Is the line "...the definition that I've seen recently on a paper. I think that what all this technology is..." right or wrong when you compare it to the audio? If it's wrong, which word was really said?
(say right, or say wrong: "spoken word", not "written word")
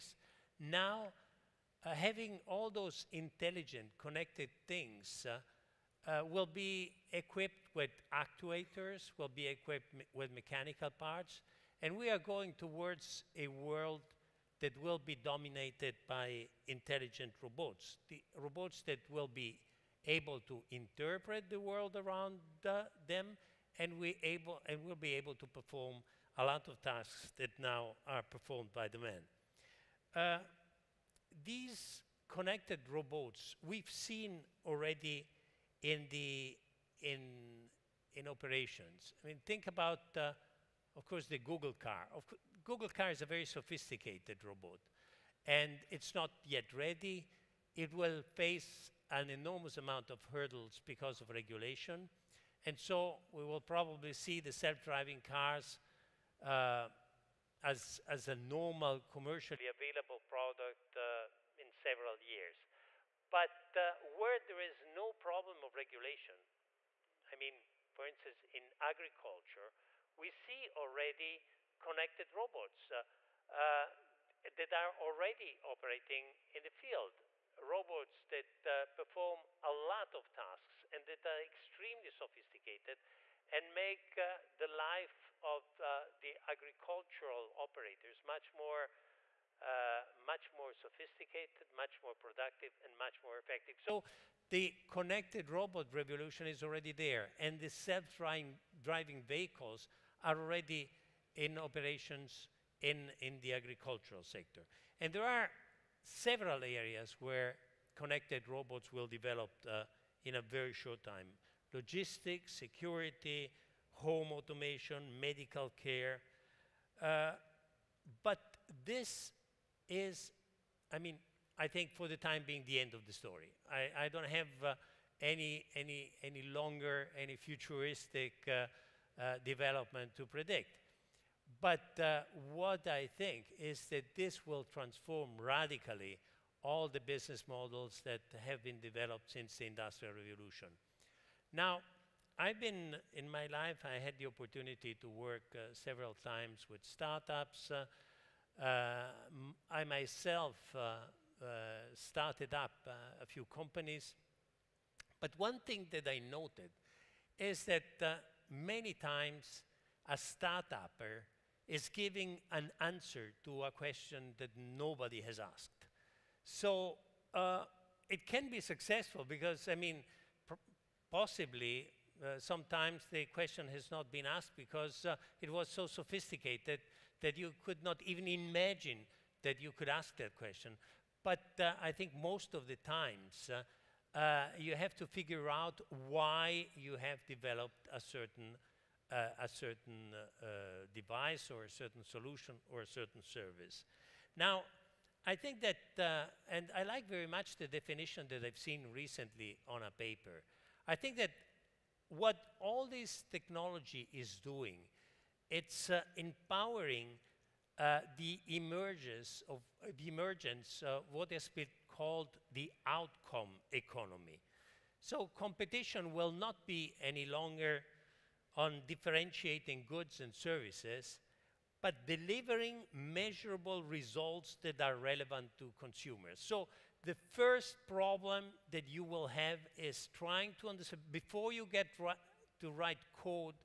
right.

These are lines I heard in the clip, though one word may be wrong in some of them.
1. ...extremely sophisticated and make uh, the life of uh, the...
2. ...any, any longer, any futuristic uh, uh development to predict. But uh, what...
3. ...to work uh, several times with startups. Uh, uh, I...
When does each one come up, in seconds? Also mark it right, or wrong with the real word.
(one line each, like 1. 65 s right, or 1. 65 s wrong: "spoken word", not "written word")
1. 81 s right
2. 125 s right
3. 144 s right.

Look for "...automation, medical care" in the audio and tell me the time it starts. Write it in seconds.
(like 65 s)
114 s.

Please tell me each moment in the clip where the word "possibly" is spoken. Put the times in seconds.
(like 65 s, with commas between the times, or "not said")
171 s.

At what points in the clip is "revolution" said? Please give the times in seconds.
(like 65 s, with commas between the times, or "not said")
95 s, 140 s.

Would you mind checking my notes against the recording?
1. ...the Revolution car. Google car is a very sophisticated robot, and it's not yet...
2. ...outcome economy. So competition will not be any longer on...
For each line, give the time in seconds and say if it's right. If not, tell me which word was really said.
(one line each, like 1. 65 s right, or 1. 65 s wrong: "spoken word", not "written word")
1. 41 s wrong: "Google", not "Revolution"
2. 212 s right.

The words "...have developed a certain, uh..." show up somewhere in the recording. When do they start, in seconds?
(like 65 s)
186 s.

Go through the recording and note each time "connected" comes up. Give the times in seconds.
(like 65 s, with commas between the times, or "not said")
3 s, 32 s, 71 s, 94 s, 107 s.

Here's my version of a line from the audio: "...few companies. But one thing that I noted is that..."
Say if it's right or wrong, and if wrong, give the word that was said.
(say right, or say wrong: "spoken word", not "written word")
right.